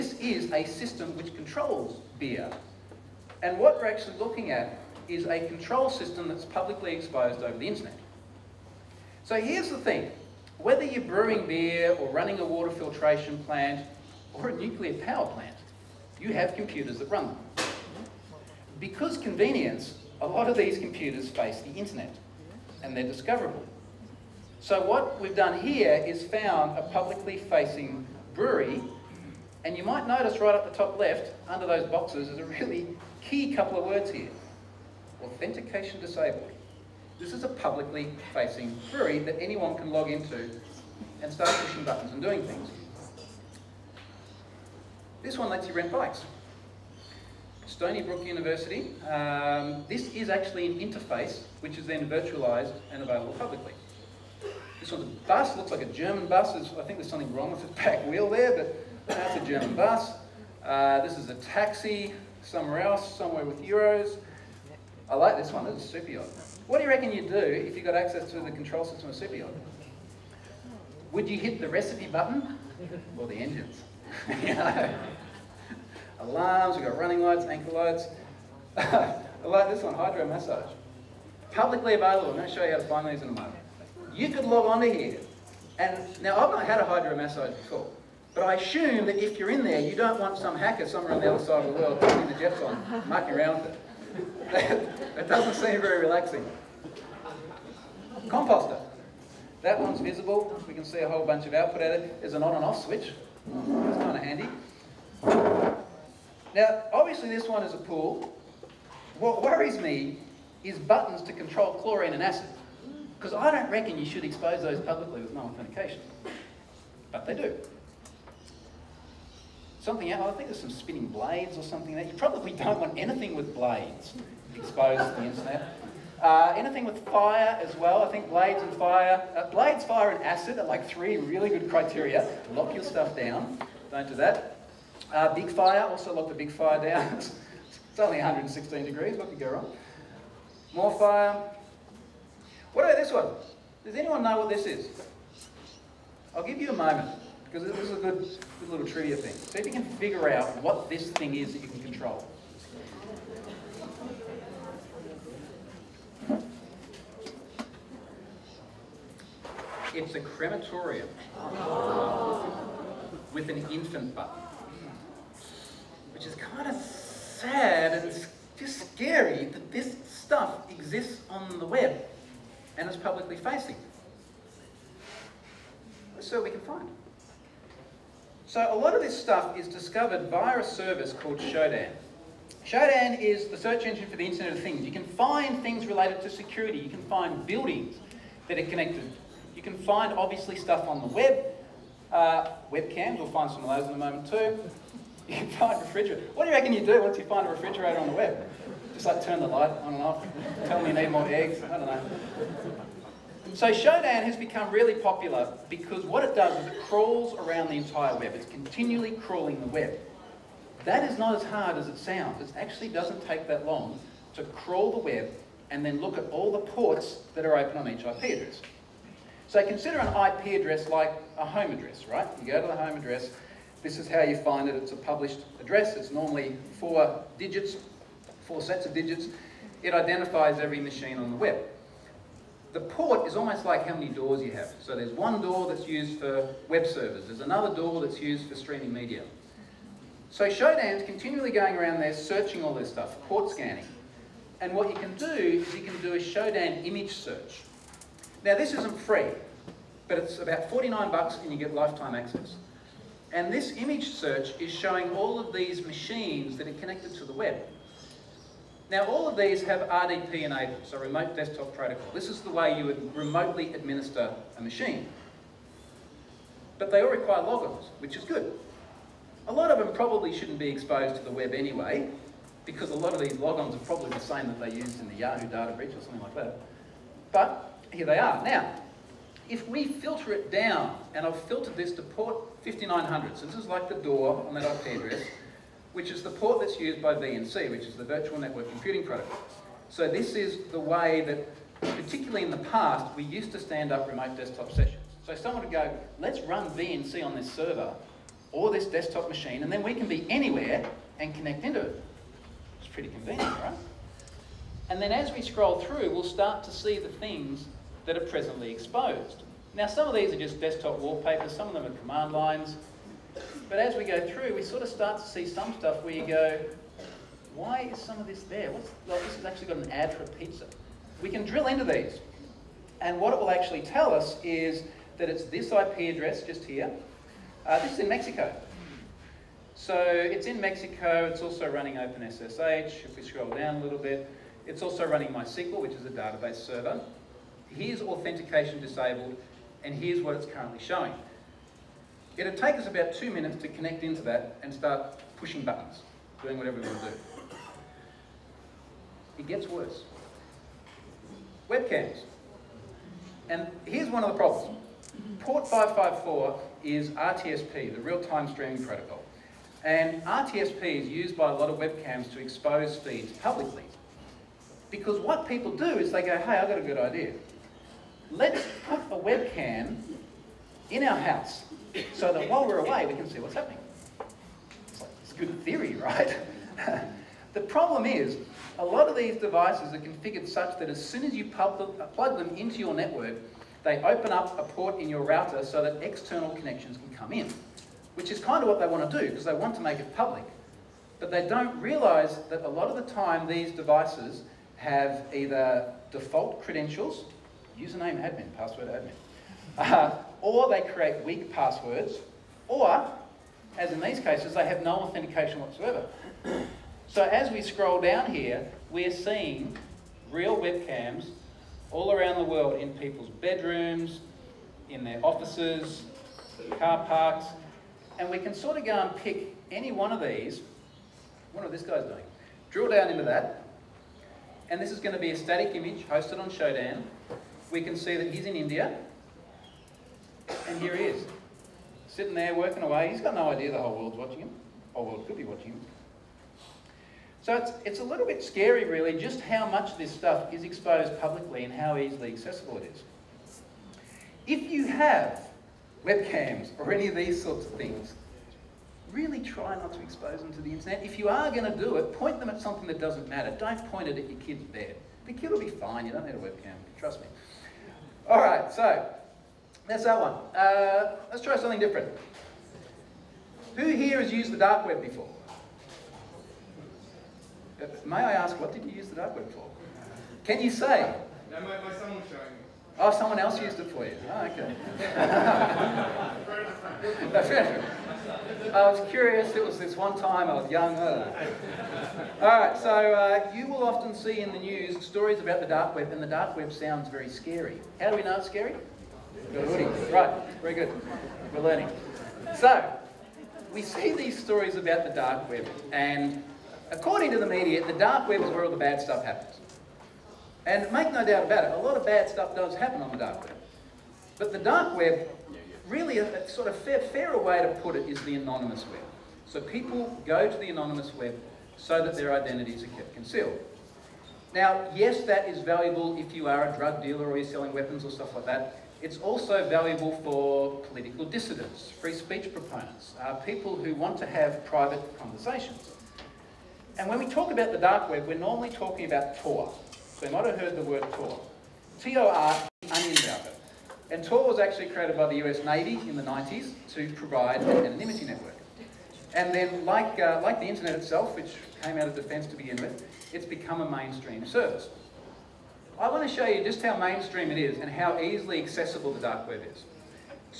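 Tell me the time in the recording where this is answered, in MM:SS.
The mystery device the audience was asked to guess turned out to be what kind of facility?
02:40.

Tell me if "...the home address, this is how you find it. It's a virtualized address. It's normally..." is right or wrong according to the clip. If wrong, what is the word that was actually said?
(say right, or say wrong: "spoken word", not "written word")
wrong: "published", not "virtualized".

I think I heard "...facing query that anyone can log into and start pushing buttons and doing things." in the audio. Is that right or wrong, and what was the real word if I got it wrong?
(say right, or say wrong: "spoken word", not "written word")
right.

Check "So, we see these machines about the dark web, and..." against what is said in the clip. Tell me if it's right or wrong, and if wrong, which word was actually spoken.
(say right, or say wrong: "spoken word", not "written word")
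wrong: "stories", not "machines".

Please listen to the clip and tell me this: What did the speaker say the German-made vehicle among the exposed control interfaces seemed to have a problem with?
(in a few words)
back wheel.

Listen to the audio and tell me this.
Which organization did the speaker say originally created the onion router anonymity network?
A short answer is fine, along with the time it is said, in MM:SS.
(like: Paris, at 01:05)
US Navy, at 08:55.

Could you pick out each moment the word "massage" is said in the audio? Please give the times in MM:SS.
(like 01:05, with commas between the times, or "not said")
01:20, 01:27.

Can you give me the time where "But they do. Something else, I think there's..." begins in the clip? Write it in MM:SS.
01:57.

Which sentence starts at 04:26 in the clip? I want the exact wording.
But they all require logins, which is good.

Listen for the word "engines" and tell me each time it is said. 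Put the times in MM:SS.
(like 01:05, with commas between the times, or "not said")
01:13, 03:03.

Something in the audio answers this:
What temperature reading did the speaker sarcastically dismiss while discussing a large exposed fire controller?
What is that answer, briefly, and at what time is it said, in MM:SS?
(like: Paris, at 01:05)
116 degrees, at 02:18.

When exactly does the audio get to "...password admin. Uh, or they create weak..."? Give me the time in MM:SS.
06:38.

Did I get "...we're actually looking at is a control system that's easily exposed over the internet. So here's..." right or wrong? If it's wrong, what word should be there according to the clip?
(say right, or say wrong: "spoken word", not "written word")
wrong: "publicly", not "easily".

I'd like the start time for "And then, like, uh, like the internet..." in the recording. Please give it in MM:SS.
08:59.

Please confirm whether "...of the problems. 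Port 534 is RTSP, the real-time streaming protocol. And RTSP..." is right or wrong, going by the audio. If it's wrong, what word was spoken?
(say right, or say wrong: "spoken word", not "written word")
wrong: "554", not "534".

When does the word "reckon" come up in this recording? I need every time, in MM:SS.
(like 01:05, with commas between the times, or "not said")
01:06, 01:53, 03:16.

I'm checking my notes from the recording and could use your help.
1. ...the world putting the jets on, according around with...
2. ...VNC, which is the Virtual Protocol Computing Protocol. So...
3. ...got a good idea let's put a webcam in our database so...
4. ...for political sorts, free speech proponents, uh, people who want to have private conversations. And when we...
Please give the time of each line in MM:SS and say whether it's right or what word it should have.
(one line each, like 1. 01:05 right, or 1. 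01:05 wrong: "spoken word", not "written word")
1. 01:31 wrong: "mucking", not "according"
2. 04:47 wrong: "Network", not "Protocol"
3. 06:06 wrong: "house", not "database"
4. 08:40 wrong: "dissidents", not "sorts".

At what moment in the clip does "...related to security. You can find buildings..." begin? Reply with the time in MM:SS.
03:05.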